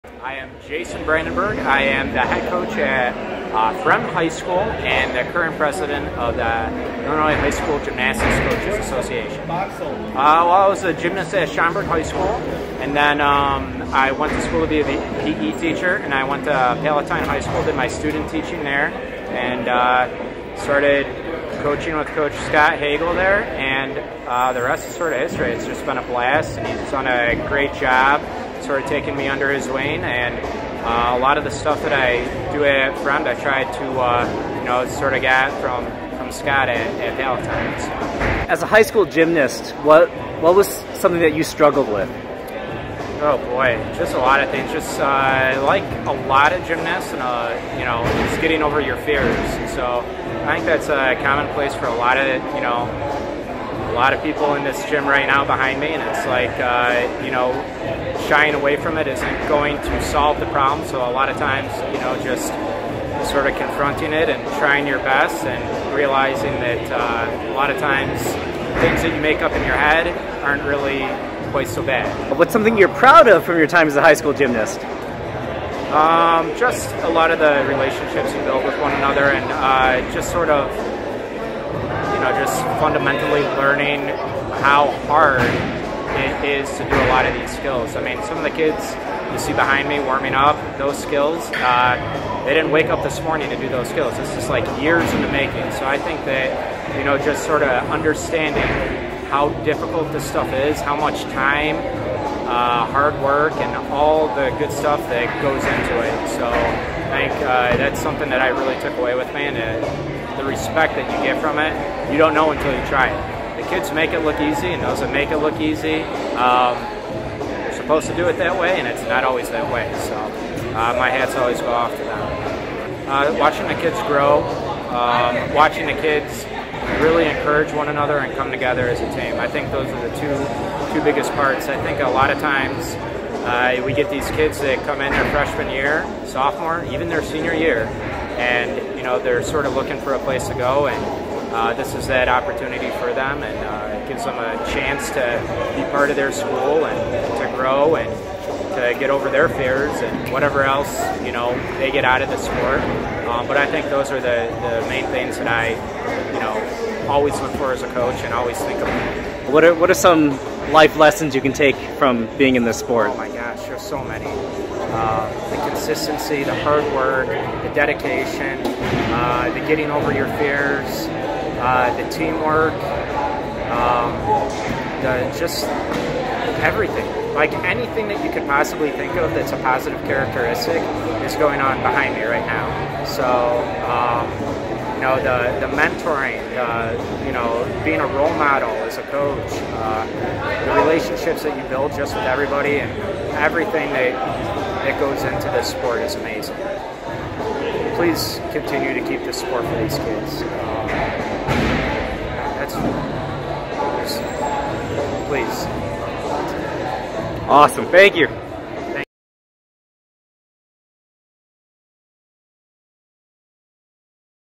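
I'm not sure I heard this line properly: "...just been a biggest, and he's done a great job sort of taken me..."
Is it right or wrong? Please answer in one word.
wrong.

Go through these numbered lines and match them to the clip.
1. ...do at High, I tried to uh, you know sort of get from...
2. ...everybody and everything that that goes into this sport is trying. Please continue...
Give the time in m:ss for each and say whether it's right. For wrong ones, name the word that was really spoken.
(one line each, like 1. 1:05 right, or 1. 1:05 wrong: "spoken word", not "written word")
1. 0:32 wrong: "Fremd", not "High"
2. 3:12 wrong: "amazing", not "trying".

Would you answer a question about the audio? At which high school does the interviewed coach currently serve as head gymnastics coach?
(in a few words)
Fremd High School.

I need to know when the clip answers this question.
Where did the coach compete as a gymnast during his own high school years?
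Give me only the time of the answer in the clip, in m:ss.
0:11.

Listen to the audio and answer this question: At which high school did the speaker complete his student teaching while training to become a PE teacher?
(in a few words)
Palatine High School.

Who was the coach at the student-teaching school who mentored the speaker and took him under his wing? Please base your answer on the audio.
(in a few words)
Scott Hagel.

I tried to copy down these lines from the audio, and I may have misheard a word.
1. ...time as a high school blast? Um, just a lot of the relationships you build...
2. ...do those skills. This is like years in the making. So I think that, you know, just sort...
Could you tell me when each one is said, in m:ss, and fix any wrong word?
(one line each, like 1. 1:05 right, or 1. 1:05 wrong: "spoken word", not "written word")
1. 1:13 wrong: "gymnast", not "blast"
2. 1:33 right.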